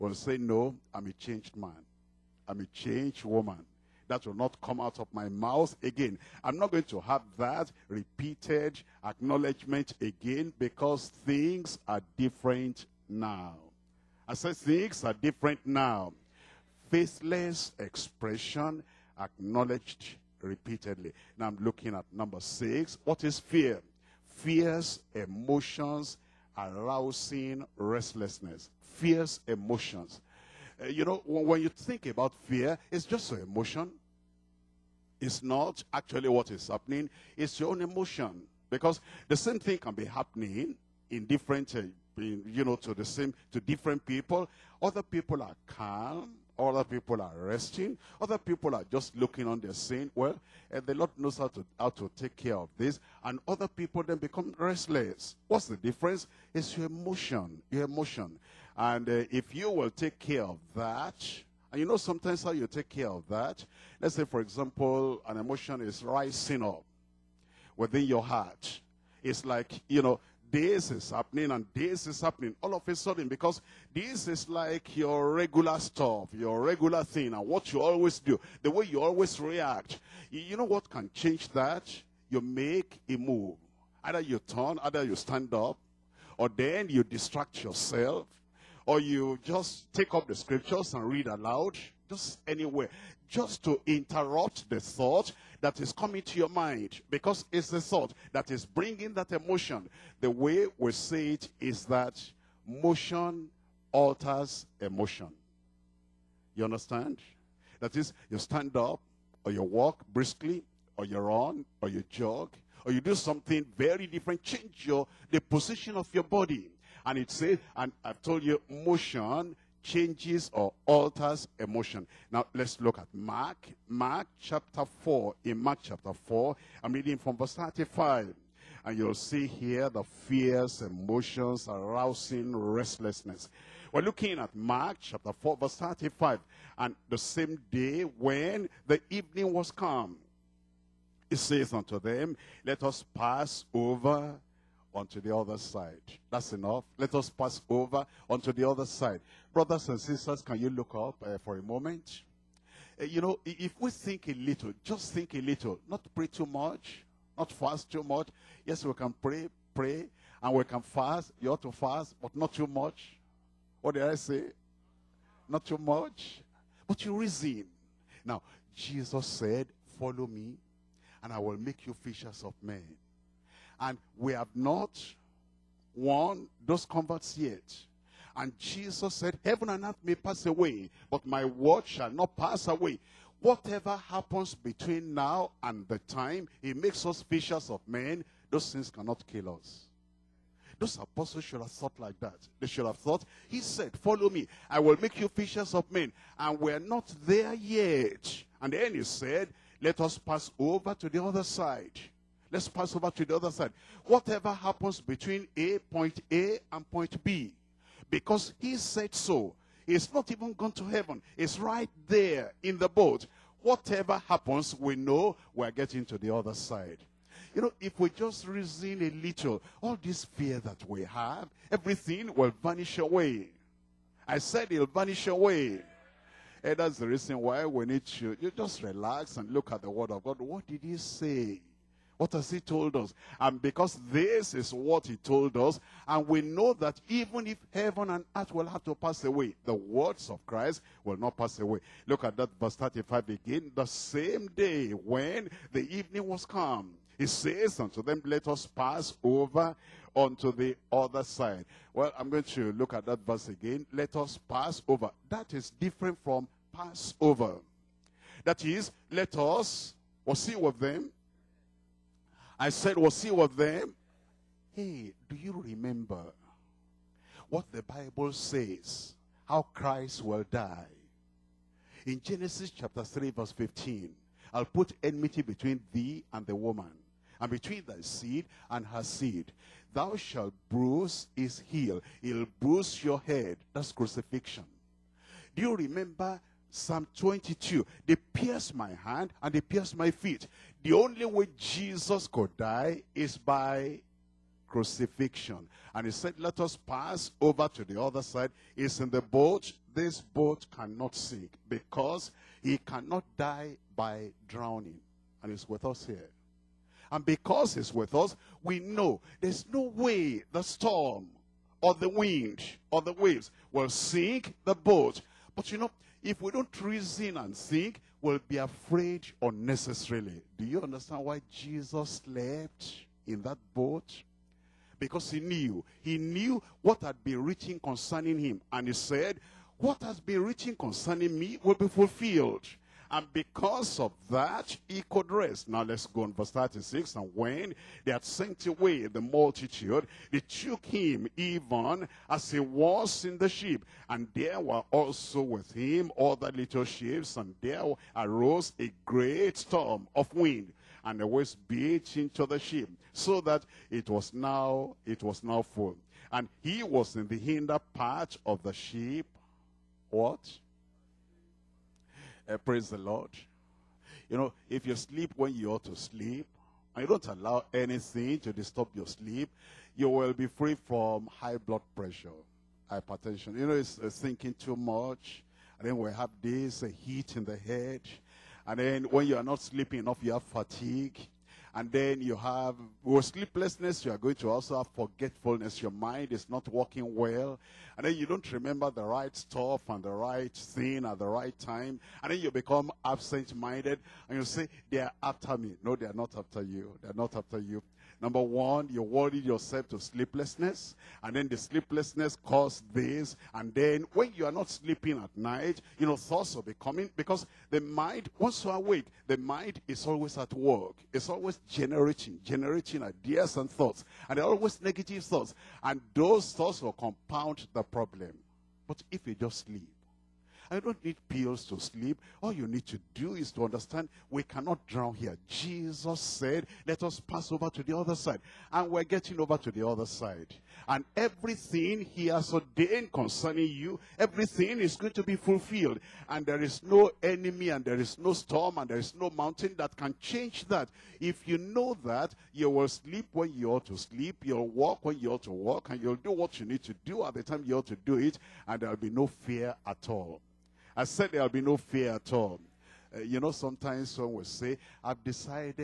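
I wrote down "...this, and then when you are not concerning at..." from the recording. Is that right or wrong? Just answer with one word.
wrong.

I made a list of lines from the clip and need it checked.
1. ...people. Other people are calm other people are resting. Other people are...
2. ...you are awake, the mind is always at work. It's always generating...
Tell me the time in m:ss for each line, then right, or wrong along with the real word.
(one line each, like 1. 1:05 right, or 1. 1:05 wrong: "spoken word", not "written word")
1. 0:44 right
2. 6:48 right.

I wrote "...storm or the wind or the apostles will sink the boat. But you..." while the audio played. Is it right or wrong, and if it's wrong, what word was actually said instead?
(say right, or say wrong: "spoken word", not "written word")
wrong: "waves", not "apostles".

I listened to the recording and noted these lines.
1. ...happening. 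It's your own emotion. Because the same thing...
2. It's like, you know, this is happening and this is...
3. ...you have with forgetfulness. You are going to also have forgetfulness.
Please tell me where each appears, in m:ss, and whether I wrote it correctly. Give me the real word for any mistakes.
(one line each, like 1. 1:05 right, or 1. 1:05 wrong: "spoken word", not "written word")
1. 0:36 right
2. 1:09 right
3. 6:22 wrong: "sleeplessness", not "forgetfulness".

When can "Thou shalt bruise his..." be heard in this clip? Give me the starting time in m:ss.
4:39.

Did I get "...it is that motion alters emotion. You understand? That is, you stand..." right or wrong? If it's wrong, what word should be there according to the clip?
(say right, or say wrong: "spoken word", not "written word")
right.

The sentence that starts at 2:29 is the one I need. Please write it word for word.
Brothers and sisters, can you look up uh, for a moment?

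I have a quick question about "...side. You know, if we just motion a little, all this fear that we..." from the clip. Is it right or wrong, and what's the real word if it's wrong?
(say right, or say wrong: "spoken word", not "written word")
wrong: "reason", not "motion".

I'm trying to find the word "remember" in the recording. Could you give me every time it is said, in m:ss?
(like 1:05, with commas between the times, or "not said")
4:25, 4:45, 6:28.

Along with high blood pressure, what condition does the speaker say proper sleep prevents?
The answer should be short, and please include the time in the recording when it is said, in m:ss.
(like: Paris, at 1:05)
hypertension, at 6:12.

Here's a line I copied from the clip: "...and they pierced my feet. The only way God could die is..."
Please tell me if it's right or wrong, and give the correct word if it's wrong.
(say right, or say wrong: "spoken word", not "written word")
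wrong: "Jesus", not "God".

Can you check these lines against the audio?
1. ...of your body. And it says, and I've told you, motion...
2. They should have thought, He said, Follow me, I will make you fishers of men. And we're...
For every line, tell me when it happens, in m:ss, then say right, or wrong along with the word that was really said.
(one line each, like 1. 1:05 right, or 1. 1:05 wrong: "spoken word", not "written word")
1. 1:55 right
2. 3:12 right.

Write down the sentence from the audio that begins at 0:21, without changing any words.
Now I'm looking at number six.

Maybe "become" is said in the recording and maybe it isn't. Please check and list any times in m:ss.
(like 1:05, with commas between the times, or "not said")
0:54, 6:32.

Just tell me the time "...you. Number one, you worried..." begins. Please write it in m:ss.
6:37.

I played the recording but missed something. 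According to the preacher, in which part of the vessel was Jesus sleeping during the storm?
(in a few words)
the hinder part.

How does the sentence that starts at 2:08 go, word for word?
And you'll see here the fears, emotions, arousing restlessness.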